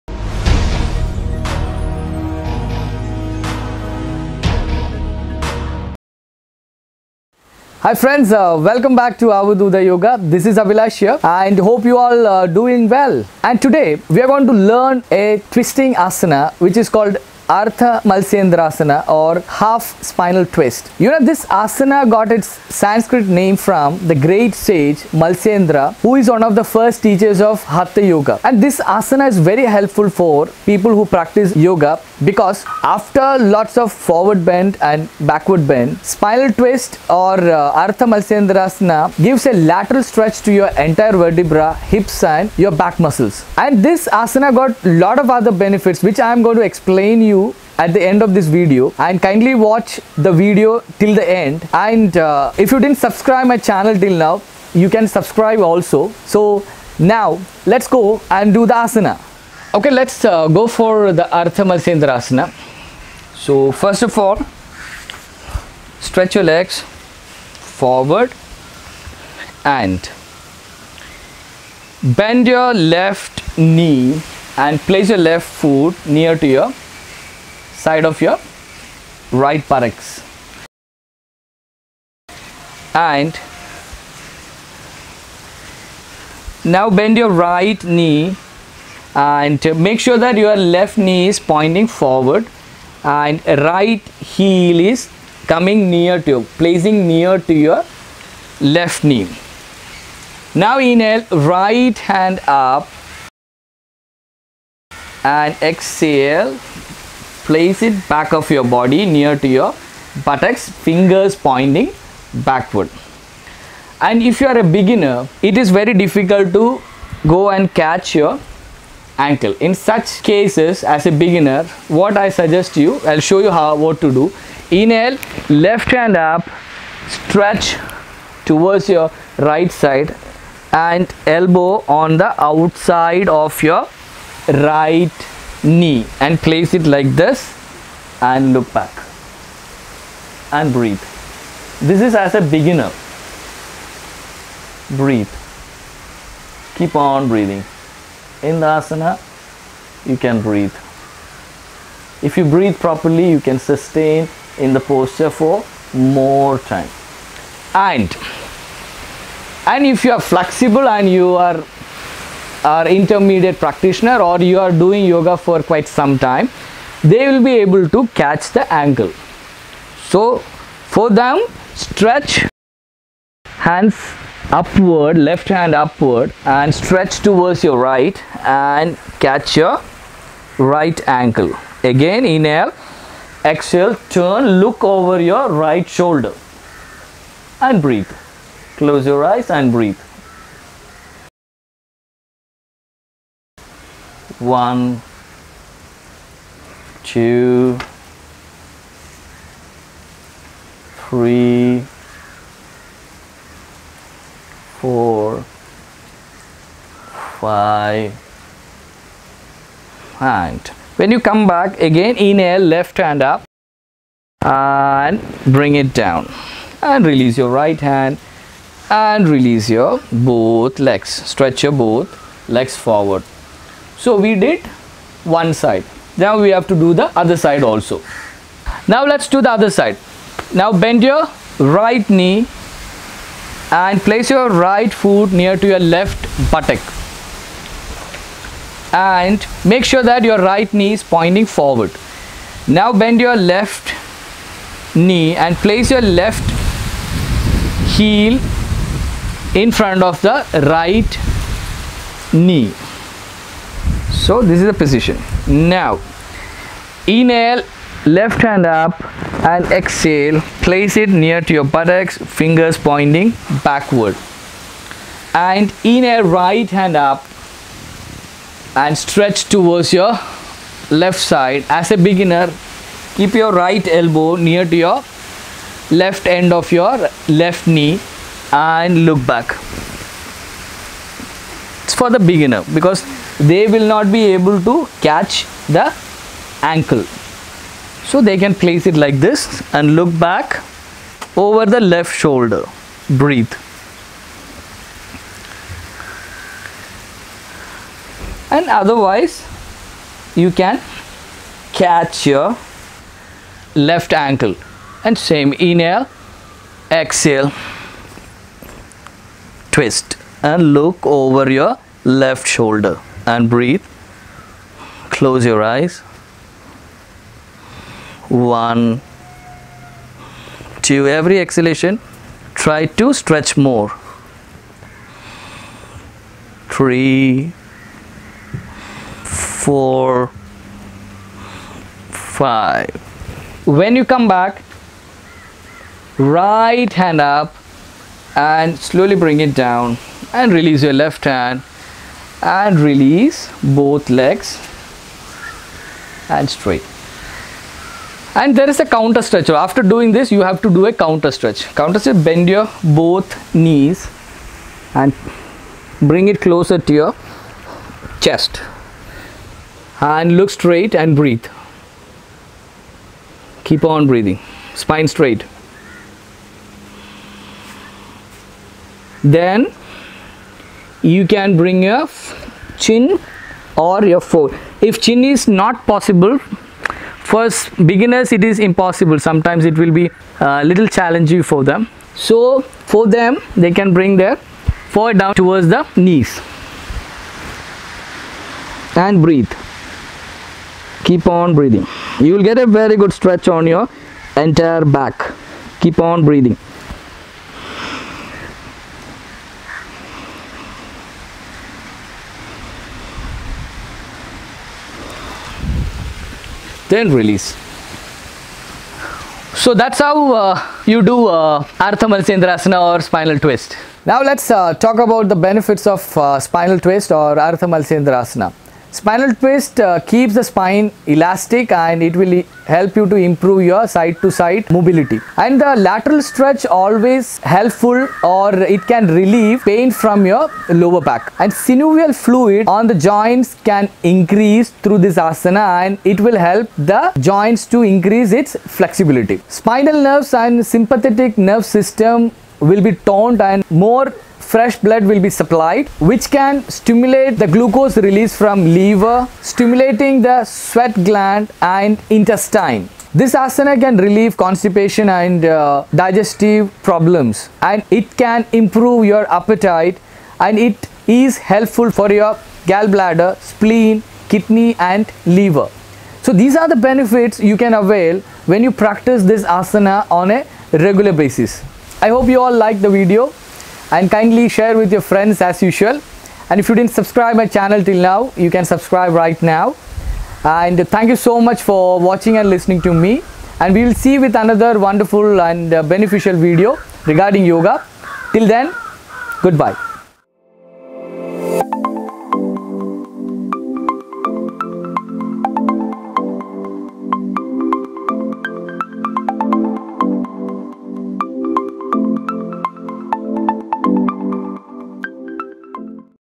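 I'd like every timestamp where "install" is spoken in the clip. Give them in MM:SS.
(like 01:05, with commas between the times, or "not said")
not said.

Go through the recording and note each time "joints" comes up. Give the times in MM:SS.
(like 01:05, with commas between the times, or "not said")
07:12, 07:17.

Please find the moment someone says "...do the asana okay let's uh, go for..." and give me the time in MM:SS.
00:58.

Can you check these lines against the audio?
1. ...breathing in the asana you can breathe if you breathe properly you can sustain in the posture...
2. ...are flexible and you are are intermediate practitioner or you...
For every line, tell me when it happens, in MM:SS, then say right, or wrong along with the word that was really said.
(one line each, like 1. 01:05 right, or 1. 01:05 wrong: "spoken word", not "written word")
1. 02:27 right
2. 02:40 right.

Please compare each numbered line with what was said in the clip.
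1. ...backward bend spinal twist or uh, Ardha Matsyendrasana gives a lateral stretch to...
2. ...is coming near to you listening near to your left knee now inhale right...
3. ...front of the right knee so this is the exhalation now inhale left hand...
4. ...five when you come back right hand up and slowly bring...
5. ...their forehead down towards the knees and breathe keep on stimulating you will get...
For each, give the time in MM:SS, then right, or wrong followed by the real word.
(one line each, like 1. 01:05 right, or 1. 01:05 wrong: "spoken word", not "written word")
1. 00:35 right
2. 01:34 wrong: "placing", not "listening"
3. 04:09 wrong: "position", not "exhalation"
4. 05:32 right
5. 06:24 wrong: "breathing", not "stimulating".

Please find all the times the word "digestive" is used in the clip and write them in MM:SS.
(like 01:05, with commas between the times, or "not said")
07:35.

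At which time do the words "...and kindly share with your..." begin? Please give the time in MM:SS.
07:53.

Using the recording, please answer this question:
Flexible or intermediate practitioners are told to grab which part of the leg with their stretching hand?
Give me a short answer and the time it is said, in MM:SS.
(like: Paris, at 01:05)
right ankle, at 03:00.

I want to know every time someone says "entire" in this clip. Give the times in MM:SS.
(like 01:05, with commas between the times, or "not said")
00:40, 06:34.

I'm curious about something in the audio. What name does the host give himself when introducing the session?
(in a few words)
Abhilash.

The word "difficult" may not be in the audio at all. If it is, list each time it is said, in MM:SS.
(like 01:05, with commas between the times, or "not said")
01:56.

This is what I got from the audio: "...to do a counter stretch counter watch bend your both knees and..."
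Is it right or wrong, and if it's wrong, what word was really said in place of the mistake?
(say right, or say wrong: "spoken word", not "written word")
wrong: "stretch", not "watch".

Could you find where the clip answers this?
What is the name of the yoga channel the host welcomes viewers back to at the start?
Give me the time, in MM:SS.
00:09.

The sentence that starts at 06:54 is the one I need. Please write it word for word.
Now let's uh, talk about the benefits of uh, spinal twist or Ardha Matsyendrasana.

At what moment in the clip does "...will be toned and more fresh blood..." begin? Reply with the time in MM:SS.
07:22.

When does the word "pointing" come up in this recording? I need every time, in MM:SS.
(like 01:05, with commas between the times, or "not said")
01:31, 01:51, 04:01, 04:22.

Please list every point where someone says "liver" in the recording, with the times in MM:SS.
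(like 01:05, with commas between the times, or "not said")
07:28, 07:45.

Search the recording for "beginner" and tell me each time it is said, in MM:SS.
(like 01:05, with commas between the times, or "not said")
01:54, 02:01, 02:22, 04:32, 04:42, 06:17.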